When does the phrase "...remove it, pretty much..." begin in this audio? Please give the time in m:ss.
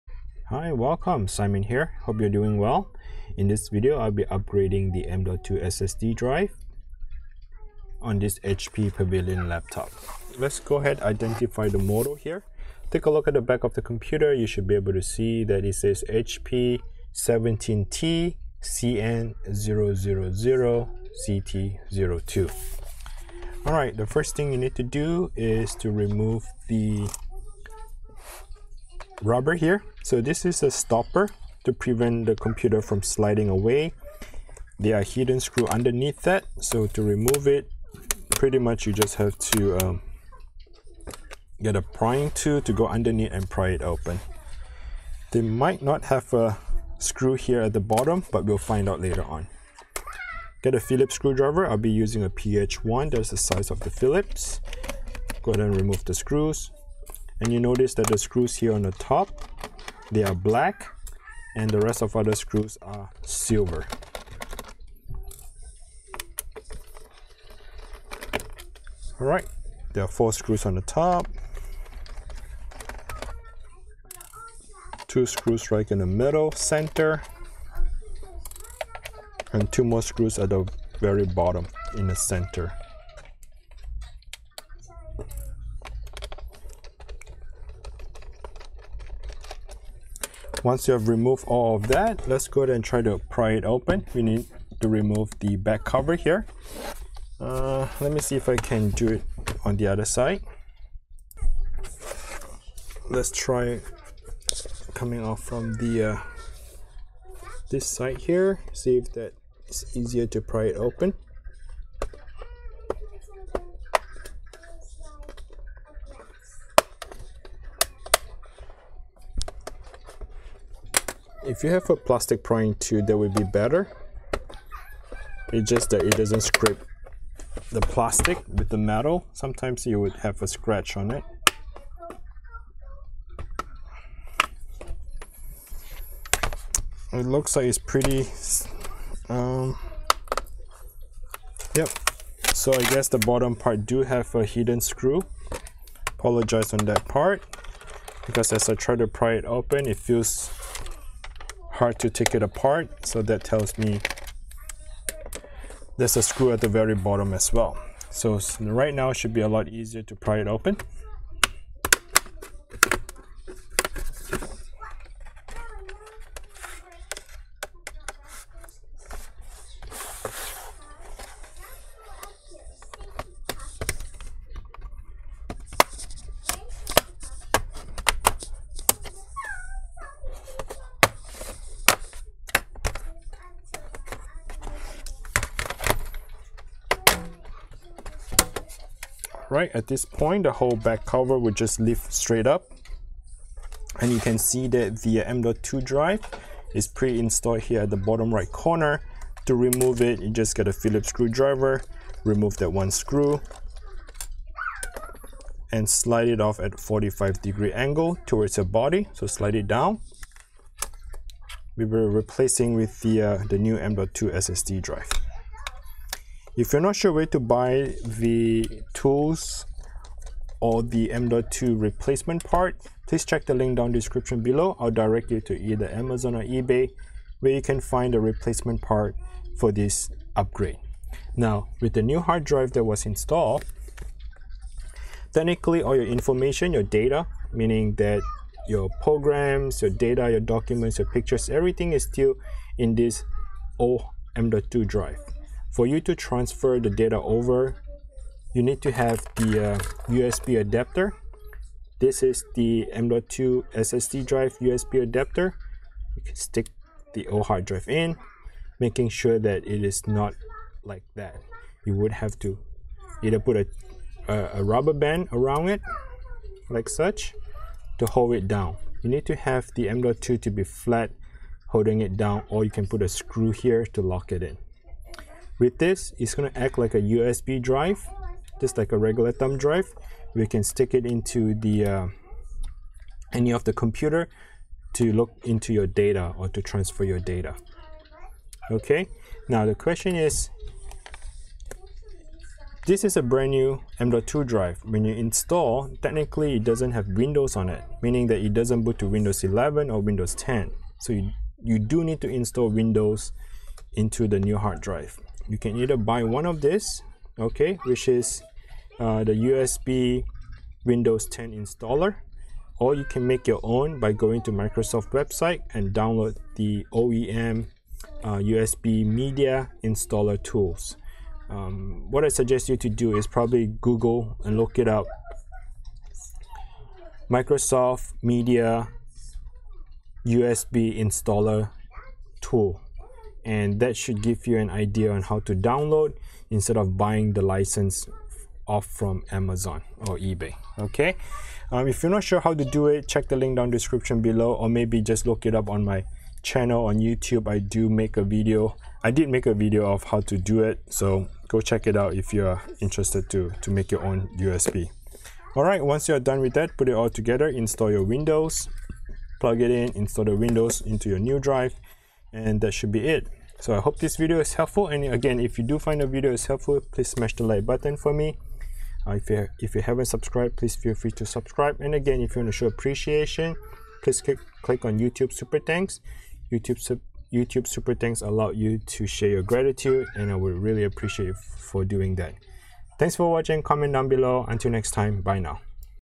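0:37.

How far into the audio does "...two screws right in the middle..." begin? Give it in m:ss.
1:15.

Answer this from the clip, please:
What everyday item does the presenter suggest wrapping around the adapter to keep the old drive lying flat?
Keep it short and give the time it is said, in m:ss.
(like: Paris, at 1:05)
Rubber band, at 4:24.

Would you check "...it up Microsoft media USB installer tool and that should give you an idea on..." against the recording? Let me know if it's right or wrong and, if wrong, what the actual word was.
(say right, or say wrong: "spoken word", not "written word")
right.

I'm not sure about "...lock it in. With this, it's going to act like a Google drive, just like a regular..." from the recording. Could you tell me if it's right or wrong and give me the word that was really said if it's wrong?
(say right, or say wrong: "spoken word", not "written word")
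wrong: "USB", not "Google".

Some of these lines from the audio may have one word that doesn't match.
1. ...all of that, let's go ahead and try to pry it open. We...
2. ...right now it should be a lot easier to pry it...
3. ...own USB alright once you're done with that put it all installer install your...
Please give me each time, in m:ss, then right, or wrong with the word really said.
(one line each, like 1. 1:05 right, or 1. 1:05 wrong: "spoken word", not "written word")
1. 1:31 right
2. 2:38 right
3. 5:54 wrong: "together", not "installer".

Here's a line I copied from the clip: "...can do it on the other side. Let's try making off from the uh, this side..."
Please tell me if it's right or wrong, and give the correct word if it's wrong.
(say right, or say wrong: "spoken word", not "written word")
wrong: "coming", not "making".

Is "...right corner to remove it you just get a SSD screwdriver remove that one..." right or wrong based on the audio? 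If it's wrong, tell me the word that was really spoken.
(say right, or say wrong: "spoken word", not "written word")
wrong: "Phillips", not "SSD".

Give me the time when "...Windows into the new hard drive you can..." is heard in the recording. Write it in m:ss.
5:02.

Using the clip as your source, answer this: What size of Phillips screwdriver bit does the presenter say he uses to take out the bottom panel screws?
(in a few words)
PH1.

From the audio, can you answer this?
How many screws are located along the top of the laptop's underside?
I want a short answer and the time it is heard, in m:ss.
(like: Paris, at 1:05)
4, at 1:10.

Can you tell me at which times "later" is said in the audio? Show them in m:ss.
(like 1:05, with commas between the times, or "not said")
0:48.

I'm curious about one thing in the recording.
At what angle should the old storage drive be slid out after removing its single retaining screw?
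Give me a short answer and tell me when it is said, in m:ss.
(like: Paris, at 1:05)
45 degrees, at 3:26.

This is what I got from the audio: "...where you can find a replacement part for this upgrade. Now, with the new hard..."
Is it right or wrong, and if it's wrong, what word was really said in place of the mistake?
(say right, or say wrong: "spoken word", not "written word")
right.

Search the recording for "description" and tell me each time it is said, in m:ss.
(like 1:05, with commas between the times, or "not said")
3:43, 5:43.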